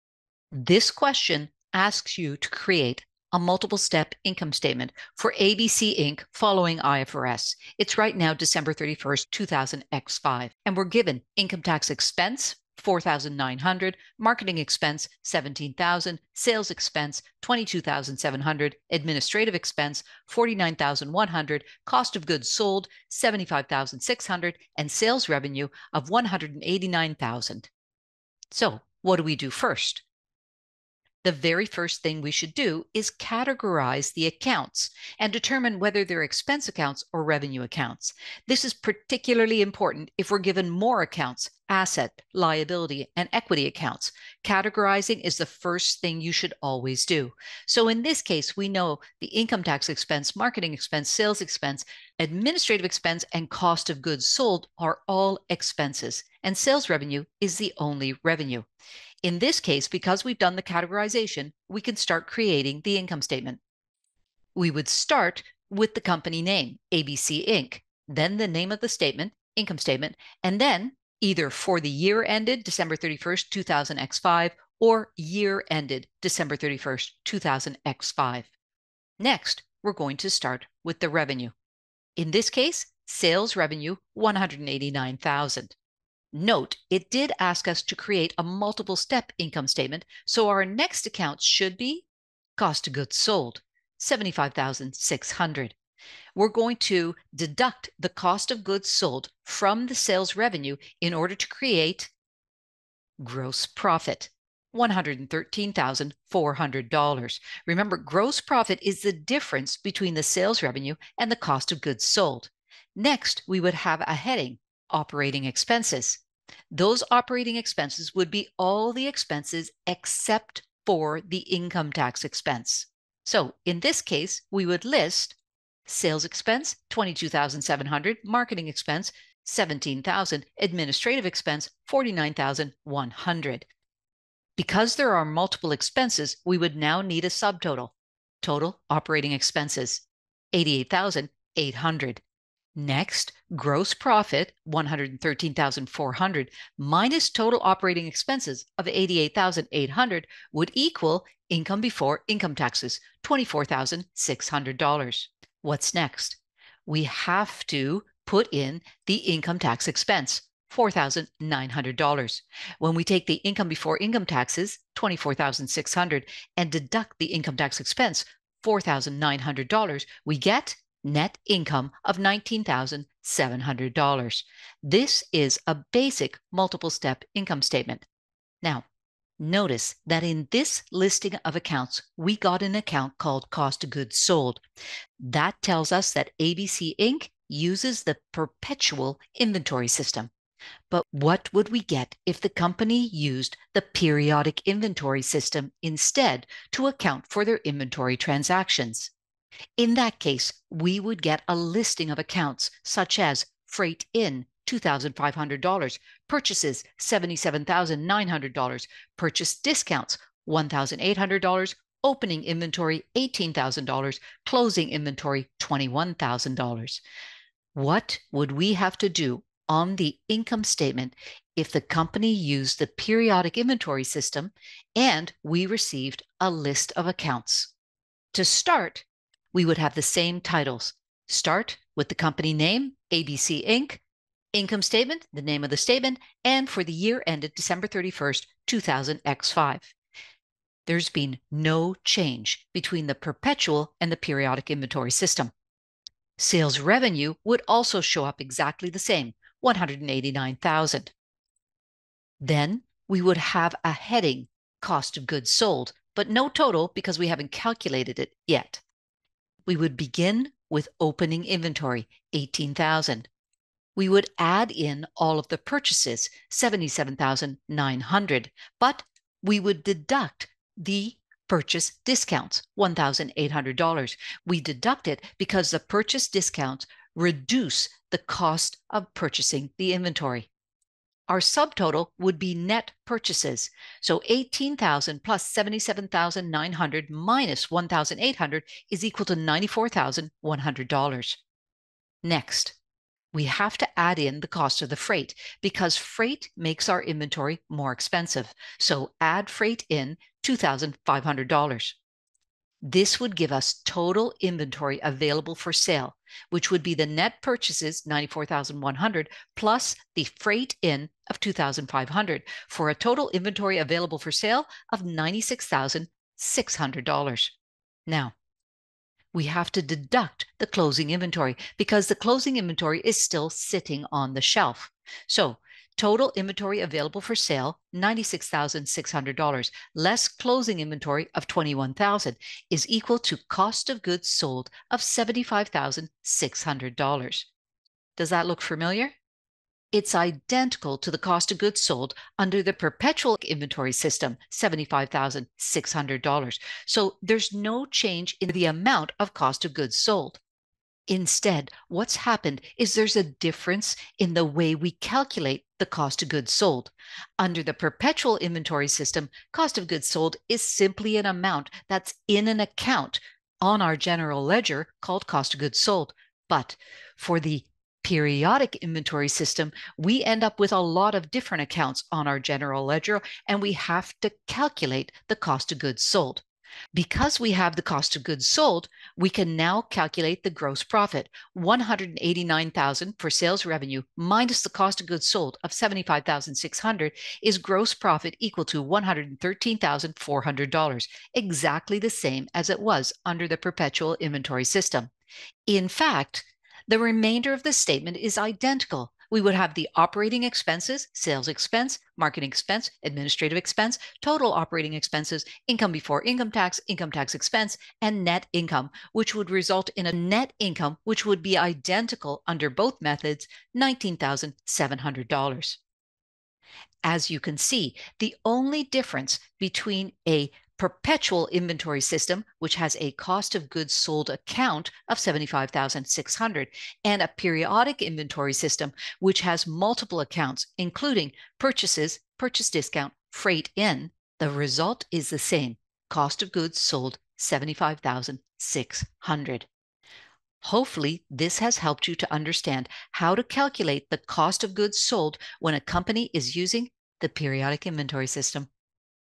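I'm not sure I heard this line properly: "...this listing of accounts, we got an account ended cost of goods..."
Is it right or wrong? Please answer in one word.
wrong.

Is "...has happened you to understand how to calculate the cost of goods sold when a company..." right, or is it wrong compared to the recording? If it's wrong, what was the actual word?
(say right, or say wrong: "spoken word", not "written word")
wrong: "helped", not "happened".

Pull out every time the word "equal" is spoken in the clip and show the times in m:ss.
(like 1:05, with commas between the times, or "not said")
4:49, 5:32, 6:28.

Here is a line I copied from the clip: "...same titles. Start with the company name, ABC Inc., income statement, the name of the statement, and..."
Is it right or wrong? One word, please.
right.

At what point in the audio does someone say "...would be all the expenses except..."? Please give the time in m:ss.
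1:58.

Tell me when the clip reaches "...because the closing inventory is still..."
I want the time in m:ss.
5:21.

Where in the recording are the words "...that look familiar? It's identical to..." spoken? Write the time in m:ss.
5:38.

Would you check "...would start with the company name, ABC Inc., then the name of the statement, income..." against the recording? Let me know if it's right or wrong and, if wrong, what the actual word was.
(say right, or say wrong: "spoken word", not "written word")
right.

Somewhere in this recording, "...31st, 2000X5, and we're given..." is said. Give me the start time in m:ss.
0:08.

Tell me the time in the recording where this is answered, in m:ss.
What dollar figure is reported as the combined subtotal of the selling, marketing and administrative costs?
2:20.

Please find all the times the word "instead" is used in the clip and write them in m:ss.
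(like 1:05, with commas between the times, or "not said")
3:15, 5:51.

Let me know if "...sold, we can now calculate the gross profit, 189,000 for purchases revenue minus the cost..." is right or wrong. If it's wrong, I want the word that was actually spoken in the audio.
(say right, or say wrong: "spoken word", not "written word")
wrong: "sales", not "purchases".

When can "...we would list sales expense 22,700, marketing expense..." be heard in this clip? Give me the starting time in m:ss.
2:04.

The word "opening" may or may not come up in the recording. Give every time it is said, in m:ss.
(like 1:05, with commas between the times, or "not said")
3:32, 4:20.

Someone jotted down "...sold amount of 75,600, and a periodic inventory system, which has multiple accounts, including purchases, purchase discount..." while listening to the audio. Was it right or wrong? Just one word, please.
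wrong.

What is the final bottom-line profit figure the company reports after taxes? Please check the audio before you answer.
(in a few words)
$19,700.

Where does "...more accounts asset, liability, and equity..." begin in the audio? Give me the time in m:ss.
0:40.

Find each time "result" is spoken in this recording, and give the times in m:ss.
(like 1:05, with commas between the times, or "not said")
6:49, 7:14.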